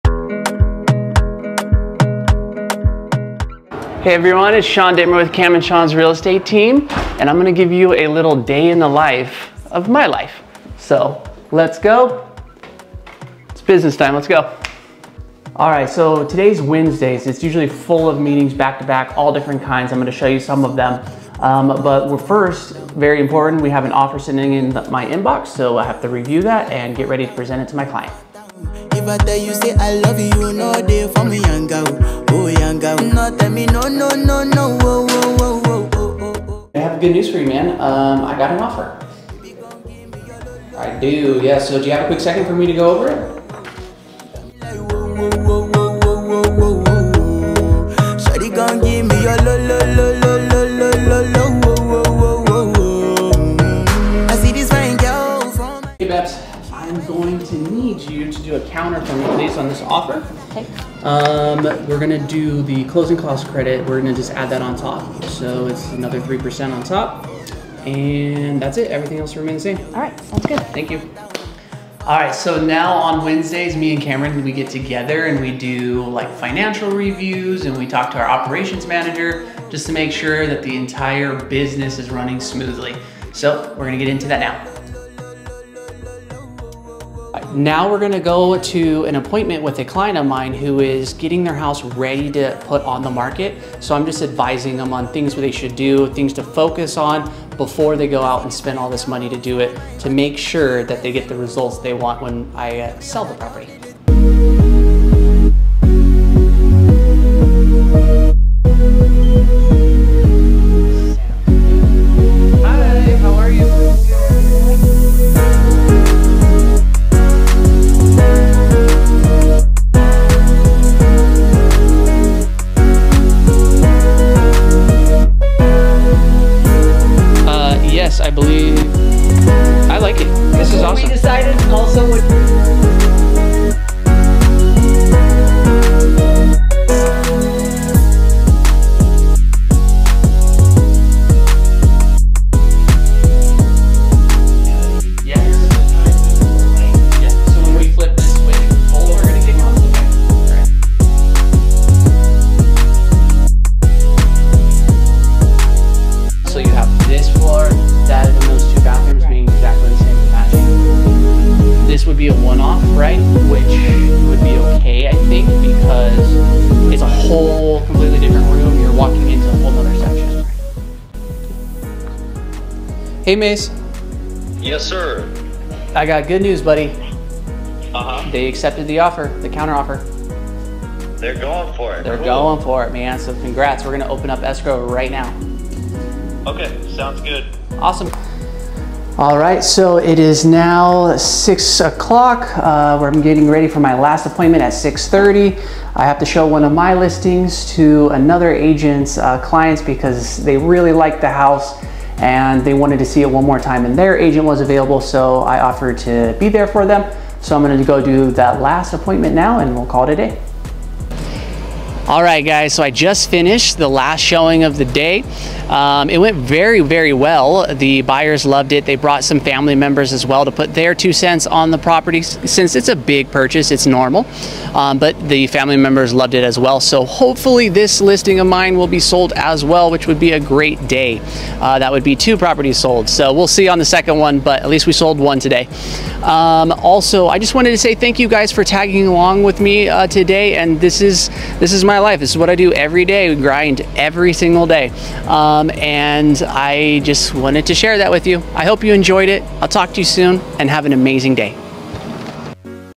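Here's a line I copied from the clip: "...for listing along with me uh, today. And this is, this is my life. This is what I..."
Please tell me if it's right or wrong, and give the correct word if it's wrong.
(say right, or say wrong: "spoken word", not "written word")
wrong: "tagging", not "listing".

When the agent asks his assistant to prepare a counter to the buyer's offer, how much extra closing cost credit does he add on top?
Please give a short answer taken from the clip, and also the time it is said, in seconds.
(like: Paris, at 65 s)
3%, at 65 s.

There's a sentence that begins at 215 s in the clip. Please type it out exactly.
Um, it went very, very well.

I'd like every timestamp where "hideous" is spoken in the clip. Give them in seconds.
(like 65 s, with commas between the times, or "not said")
not said.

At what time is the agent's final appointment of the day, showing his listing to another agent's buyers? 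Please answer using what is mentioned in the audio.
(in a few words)
6:30.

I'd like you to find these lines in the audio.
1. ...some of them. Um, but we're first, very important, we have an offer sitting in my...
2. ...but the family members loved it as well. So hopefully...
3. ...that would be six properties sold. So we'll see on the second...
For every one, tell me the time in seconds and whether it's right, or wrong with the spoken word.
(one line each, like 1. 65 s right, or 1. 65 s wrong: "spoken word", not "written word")
1. 20 s right
2. 224 s right
3. 231 s wrong: "two", not "six".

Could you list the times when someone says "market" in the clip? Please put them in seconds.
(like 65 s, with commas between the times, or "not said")
93 s.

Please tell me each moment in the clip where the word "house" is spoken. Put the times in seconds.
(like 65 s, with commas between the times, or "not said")
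91 s, 201 s.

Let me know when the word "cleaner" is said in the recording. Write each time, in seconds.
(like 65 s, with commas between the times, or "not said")
not said.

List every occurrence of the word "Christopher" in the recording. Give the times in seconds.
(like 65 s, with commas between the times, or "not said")
not said.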